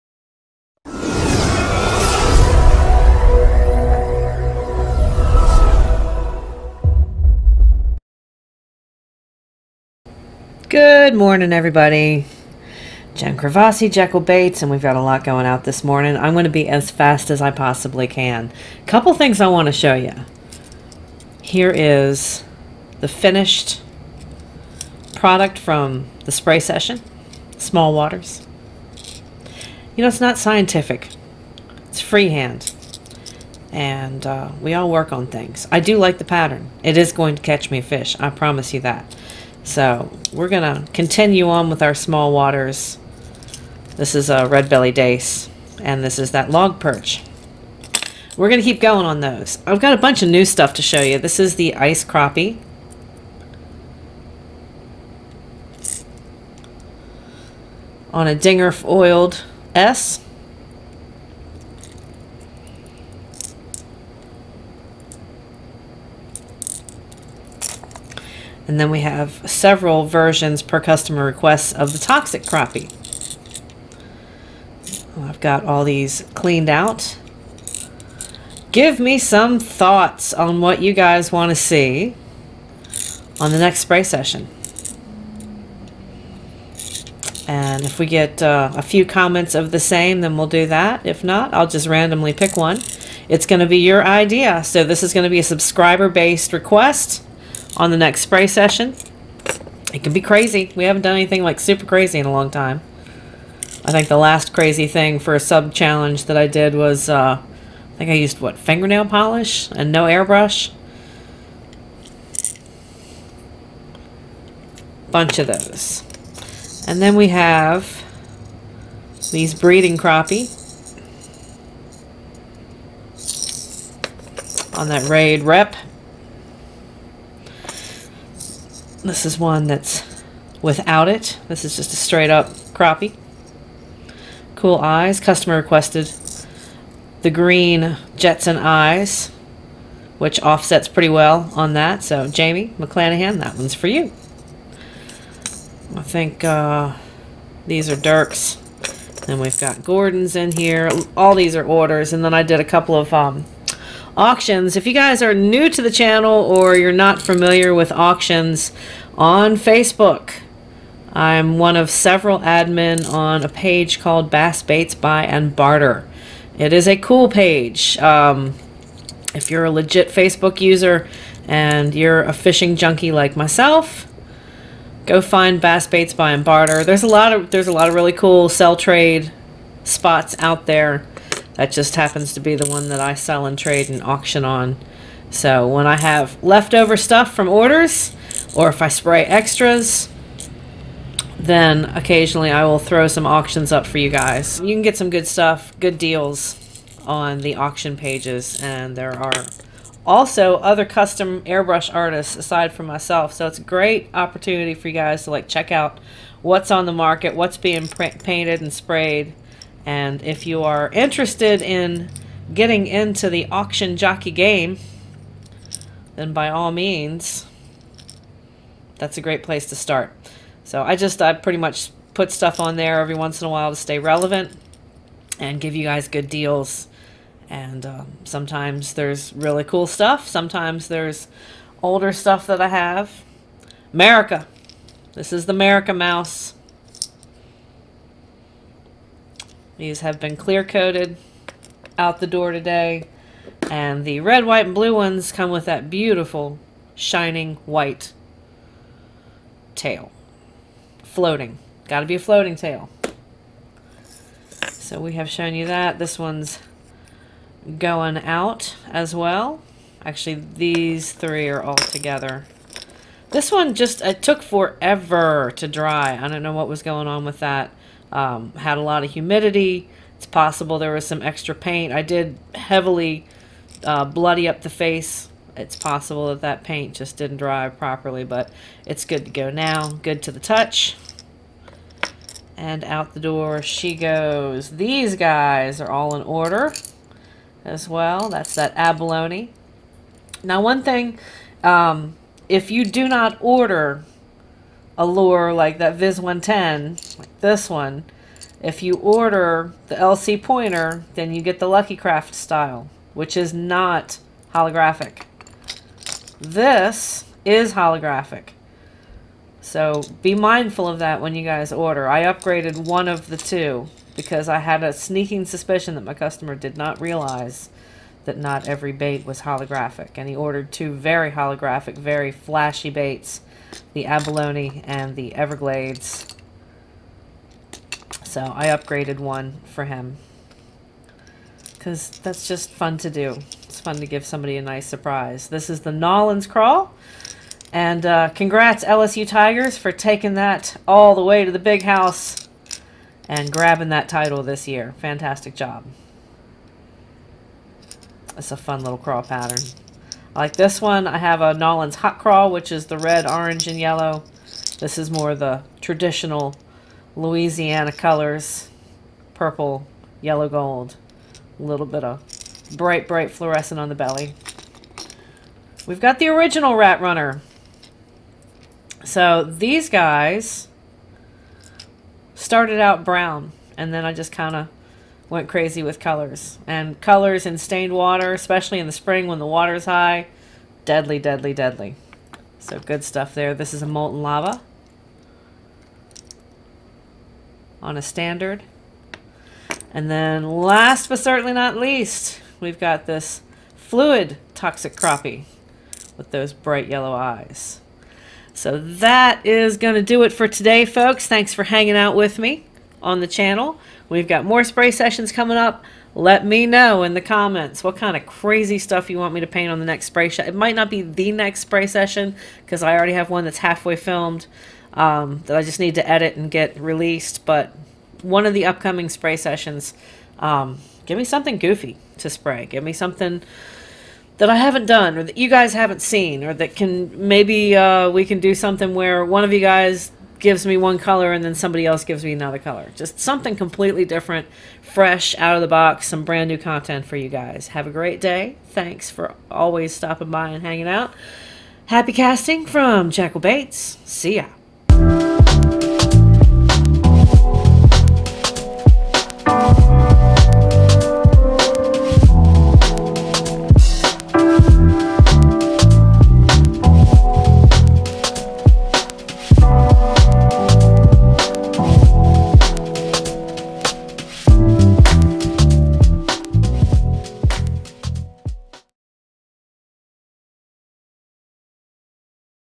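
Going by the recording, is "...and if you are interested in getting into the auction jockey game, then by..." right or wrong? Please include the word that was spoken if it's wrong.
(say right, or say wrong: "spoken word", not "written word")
right.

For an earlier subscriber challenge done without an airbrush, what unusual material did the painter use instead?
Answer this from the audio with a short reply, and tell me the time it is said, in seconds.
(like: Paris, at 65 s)
fingernail polish, at 108 s.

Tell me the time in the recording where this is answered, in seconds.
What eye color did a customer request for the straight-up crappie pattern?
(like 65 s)
137 s.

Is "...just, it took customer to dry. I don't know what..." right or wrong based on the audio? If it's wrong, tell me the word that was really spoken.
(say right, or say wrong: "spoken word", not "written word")
wrong: "forever", not "customer".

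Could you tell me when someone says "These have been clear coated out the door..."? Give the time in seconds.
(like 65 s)
239 s.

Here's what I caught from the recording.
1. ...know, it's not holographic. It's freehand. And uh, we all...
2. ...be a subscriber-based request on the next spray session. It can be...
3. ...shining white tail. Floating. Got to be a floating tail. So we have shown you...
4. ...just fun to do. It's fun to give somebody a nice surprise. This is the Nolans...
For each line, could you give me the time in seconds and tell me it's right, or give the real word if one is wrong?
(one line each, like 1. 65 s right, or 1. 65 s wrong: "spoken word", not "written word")
1. 30 s wrong: "scientific", not "holographic"
2. 95 s right
3. 246 s right
4. 332 s right.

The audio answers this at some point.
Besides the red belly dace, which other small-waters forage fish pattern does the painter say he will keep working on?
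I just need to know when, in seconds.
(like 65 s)
46 s.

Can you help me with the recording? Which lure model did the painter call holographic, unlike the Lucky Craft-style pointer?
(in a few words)
Viz 110.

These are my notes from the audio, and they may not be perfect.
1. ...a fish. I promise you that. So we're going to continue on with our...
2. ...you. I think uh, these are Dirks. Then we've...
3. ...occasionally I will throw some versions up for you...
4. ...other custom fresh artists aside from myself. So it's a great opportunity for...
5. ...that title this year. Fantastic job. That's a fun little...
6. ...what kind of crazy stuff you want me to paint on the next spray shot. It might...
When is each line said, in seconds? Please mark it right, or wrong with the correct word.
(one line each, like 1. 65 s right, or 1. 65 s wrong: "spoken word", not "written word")
1. 37 s right
2. 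143 s right
3. 191 s wrong: "auctions", not "versions"
4. 200 s wrong: "airbrush", not "fresh"
5. 343 s right
6. 407 s right.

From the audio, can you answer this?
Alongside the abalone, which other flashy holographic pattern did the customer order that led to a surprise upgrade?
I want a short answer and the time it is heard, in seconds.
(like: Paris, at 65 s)
Everglades, at 325 s.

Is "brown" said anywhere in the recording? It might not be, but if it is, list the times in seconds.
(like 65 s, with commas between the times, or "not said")
373 s.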